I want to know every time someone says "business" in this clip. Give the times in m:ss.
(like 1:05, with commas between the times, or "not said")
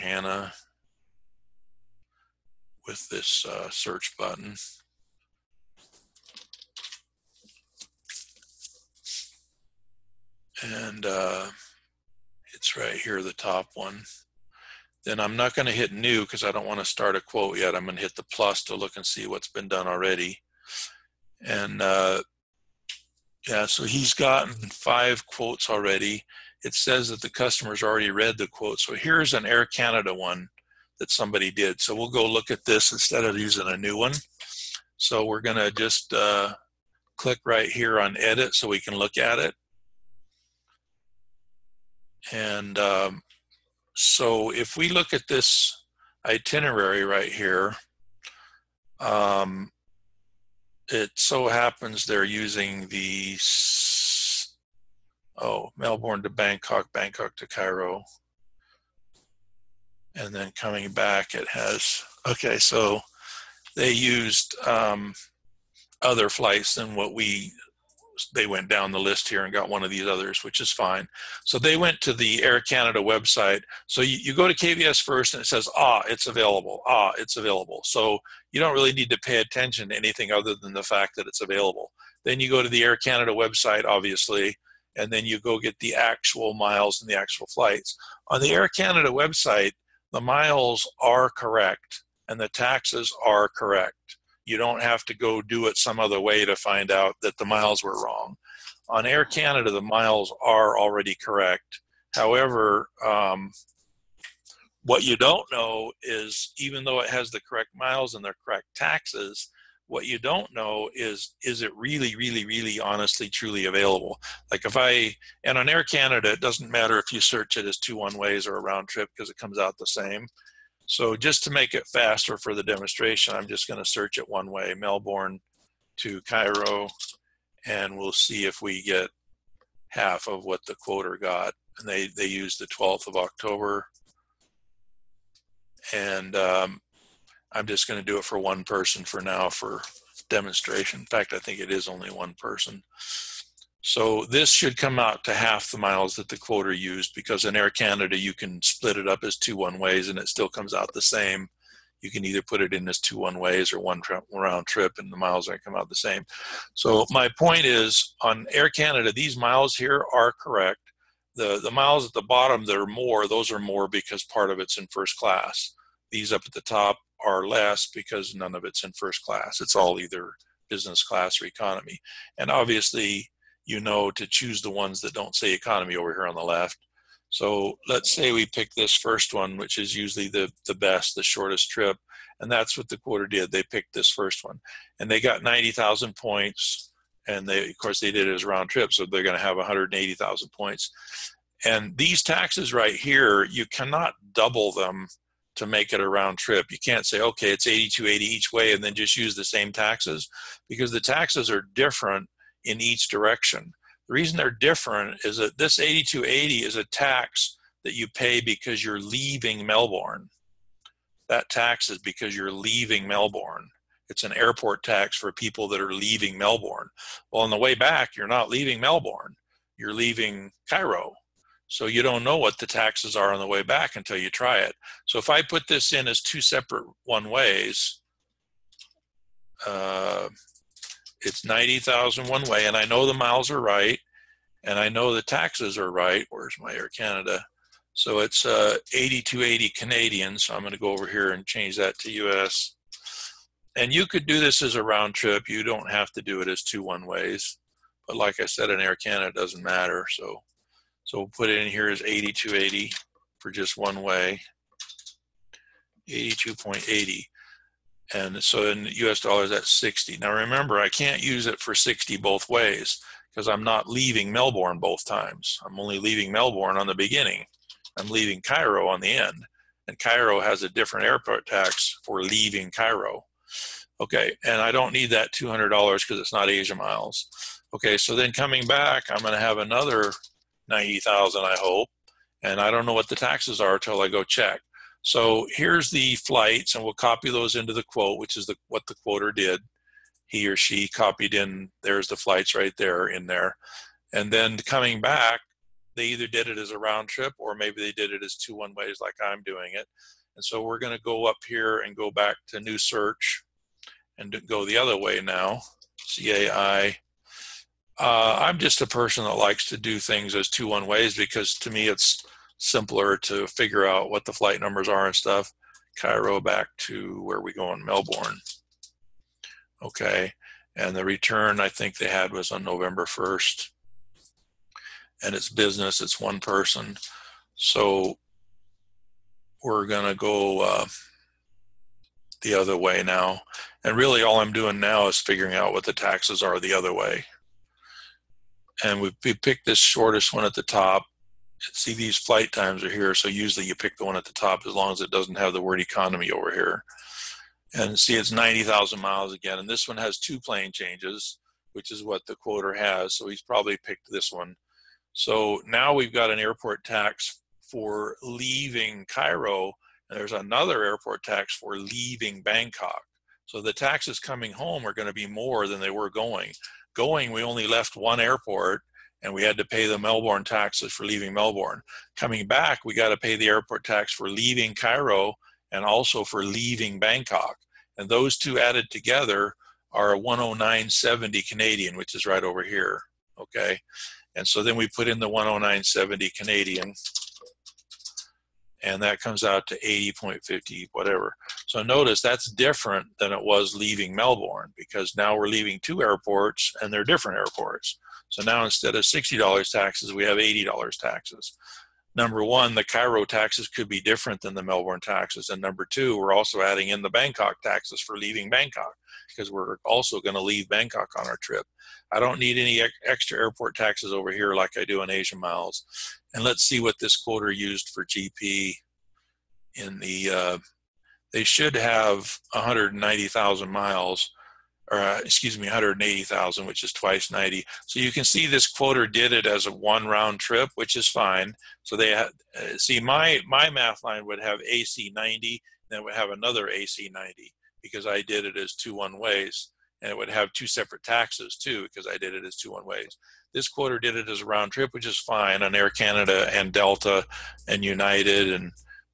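2:50, 5:25.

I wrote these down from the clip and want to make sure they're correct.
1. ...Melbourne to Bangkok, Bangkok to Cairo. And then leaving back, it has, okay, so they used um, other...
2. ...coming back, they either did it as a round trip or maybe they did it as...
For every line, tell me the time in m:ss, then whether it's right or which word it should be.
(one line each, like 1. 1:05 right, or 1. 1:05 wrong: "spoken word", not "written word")
1. 0:55 wrong: "coming", not "leaving"
2. 4:54 right.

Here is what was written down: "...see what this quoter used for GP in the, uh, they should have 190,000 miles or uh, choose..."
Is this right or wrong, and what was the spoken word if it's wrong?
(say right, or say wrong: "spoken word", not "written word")
wrong: "excuse", not "choose".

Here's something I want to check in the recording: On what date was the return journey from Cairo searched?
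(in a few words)
November 1st.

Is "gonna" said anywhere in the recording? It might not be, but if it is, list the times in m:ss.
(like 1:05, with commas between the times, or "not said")
5:29.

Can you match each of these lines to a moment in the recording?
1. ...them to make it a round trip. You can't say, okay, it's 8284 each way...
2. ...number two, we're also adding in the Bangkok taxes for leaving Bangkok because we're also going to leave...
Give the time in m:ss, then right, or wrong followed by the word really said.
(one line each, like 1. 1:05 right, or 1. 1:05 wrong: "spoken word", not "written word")
1. 3:14 wrong: "8280", not "8284"
2. 6:45 right.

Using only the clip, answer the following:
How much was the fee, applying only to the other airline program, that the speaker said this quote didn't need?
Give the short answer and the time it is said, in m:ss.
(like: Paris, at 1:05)
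$200, at 4:35.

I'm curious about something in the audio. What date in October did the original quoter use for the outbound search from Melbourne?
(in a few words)
12th of October.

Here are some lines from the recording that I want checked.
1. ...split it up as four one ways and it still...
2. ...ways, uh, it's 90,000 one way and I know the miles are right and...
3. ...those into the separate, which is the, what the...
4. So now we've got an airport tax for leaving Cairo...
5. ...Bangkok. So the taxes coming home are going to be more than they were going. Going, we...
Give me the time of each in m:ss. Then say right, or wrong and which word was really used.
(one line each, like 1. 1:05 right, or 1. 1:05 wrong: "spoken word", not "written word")
1. 2:28 wrong: "two", not "four"
2. 3:47 right
3. 4:47 wrong: "quote", not "separate"
4. 5:55 right
5. 6:02 right.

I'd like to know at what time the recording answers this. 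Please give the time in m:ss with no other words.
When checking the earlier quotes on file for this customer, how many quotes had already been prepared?
0:24.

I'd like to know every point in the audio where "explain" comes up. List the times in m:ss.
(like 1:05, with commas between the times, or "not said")
not said.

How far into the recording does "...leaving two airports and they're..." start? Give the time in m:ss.
6:35.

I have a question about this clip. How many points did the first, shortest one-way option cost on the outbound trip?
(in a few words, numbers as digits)
90,000.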